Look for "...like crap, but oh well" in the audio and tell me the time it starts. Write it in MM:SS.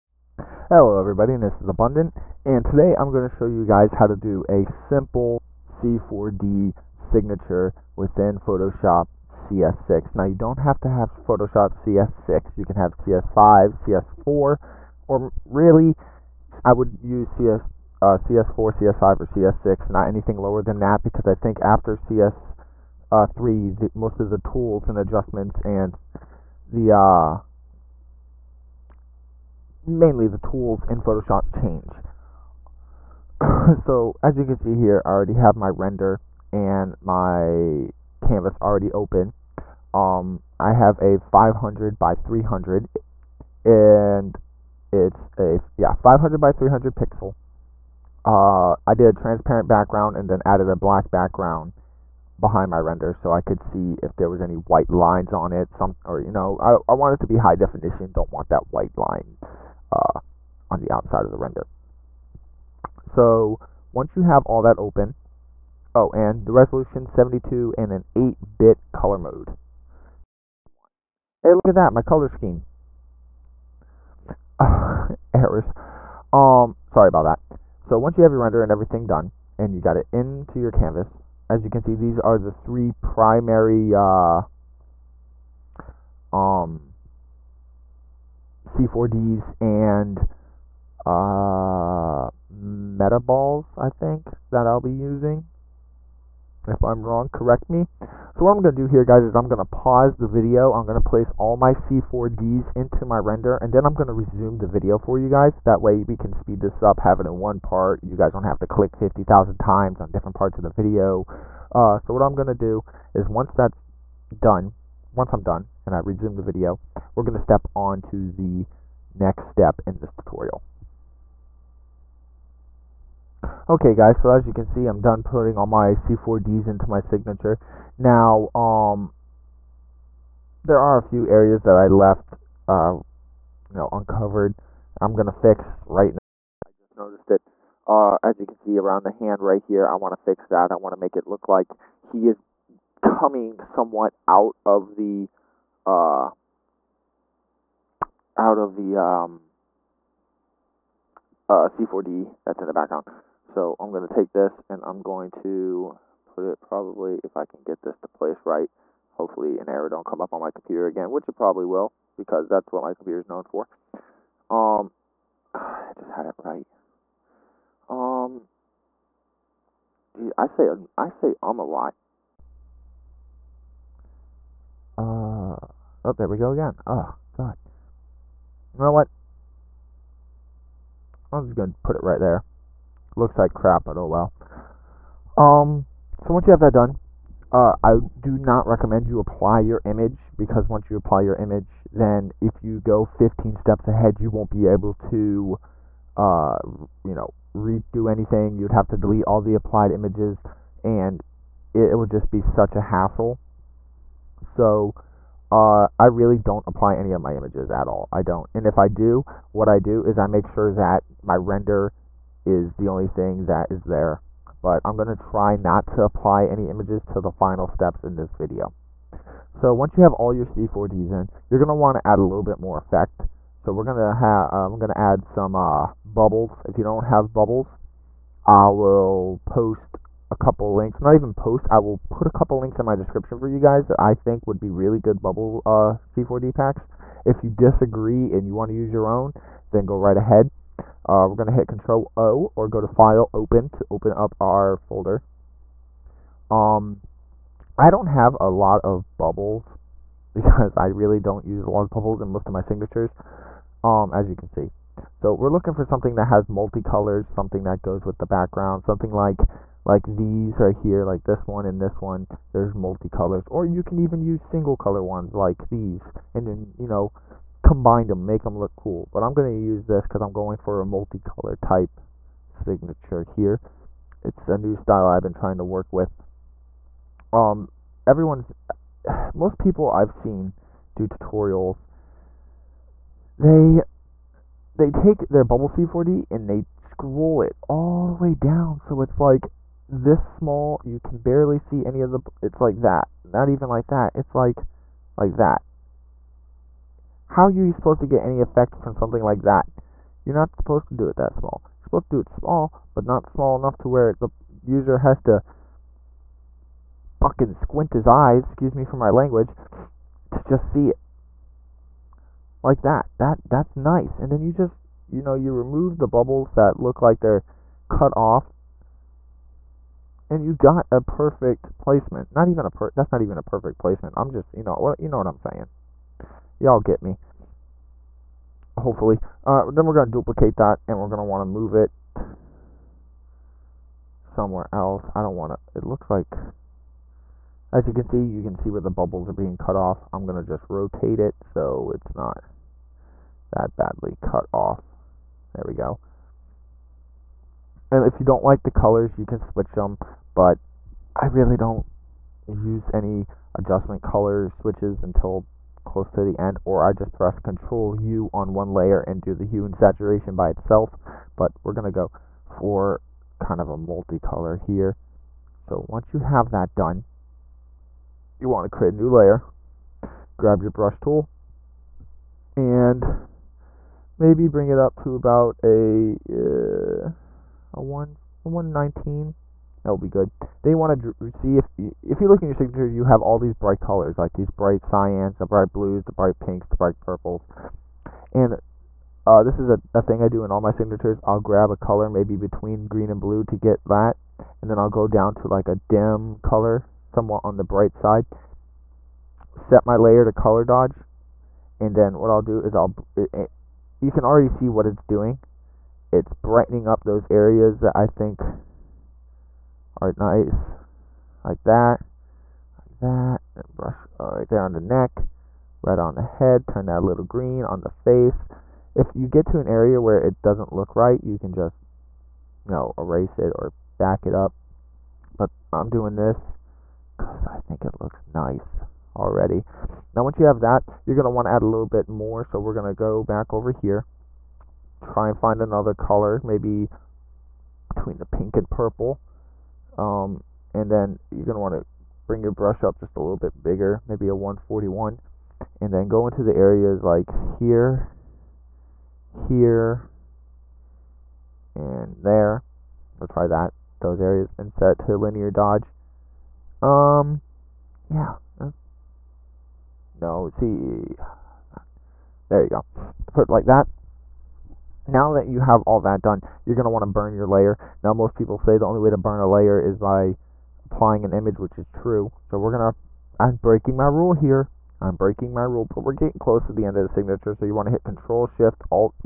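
03:03.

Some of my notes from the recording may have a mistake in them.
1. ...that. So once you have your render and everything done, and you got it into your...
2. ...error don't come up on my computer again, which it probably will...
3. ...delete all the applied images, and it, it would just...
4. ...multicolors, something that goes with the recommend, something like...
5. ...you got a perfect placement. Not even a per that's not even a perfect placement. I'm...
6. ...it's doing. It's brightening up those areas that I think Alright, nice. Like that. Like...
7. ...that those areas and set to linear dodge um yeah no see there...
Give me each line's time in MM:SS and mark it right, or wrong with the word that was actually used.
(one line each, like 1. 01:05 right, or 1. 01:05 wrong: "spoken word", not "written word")
1. 01:17 right
2. 02:39 right
3. 03:18 right
4. 04:16 wrong: "background", not "recommend"
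5. 05:20 right
6. 06:44 right
7. 07:33 right.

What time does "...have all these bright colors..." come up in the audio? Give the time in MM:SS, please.
06:23.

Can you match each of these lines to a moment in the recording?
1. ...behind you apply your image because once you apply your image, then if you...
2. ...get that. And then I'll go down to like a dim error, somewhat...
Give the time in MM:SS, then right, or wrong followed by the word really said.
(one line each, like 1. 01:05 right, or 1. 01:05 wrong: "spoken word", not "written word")
1. 03:08 wrong: "recommend", not "behind"
2. 06:33 wrong: "color", not "error".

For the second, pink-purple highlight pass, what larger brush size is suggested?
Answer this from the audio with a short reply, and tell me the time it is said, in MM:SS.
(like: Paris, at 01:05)
141, at 07:24.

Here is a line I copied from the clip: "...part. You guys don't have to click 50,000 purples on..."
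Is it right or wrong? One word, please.
wrong.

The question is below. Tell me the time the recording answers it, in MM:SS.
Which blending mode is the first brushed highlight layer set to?
06:40.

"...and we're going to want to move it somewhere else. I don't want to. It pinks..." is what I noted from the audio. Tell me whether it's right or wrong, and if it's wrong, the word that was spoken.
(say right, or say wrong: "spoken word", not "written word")
wrong: "looks", not "pinks".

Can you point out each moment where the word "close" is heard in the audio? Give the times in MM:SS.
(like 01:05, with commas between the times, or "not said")
05:55, 07:56.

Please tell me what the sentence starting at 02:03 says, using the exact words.
Okay guys, so as you can see, I'm done putting all my C4Ds into my signature.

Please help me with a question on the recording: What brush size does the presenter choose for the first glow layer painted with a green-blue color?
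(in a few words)
119.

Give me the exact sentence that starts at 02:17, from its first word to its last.
Uh, as you can see around the hand right here, I want to fix that.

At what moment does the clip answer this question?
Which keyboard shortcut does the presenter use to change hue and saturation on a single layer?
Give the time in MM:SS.
05:57.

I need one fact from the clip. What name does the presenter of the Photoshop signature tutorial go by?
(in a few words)
Abundant.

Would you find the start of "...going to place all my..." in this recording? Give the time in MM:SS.
01:40.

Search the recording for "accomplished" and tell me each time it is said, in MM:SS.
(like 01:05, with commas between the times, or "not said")
not said.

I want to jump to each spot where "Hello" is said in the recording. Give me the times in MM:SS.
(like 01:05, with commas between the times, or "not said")
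00:00.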